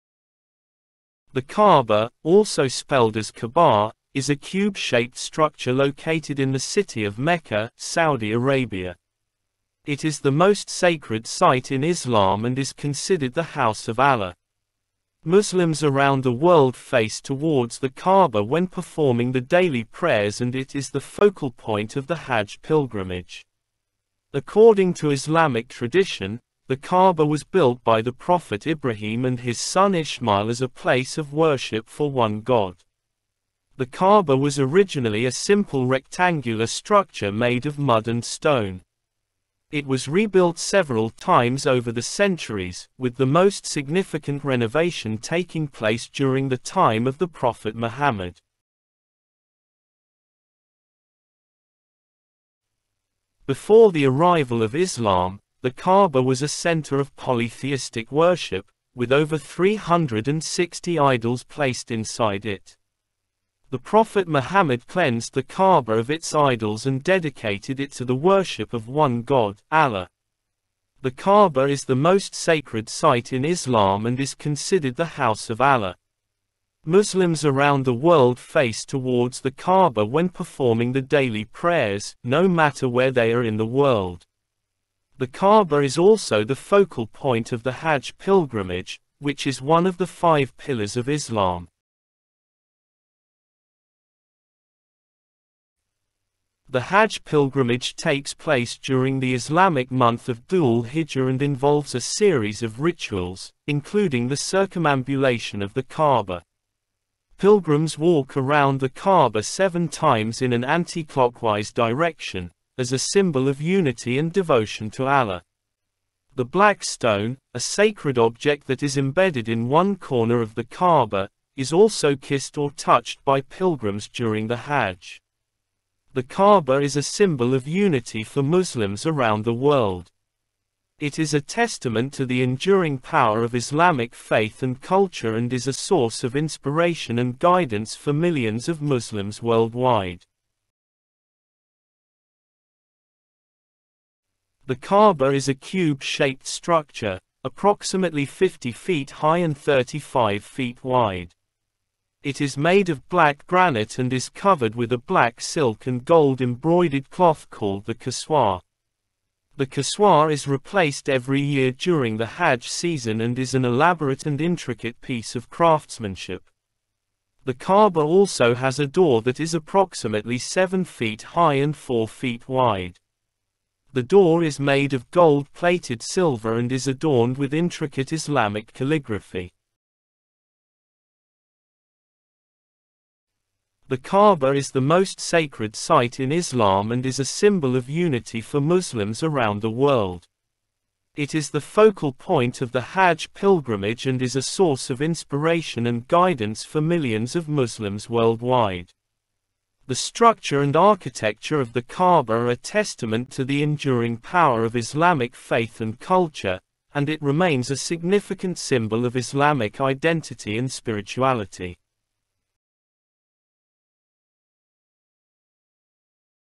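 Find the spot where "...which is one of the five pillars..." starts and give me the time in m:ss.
1:29.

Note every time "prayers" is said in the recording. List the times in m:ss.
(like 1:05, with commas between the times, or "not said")
0:19, 1:21.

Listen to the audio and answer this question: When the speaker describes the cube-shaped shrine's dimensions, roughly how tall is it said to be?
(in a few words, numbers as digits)
about 50 feet.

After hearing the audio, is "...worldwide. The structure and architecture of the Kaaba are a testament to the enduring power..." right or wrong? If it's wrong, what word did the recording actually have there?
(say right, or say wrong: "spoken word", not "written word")
right.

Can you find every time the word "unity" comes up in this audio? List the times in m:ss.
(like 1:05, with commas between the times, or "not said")
1:53, 2:07, 3:07.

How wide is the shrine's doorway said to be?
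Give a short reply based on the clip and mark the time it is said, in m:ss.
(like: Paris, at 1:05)
about 4 feet, at 2:51.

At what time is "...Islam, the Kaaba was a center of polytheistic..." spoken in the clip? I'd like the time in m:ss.
0:54.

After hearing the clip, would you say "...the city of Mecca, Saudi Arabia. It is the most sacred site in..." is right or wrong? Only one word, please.
right.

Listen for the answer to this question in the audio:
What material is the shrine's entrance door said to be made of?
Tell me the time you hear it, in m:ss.
2:55.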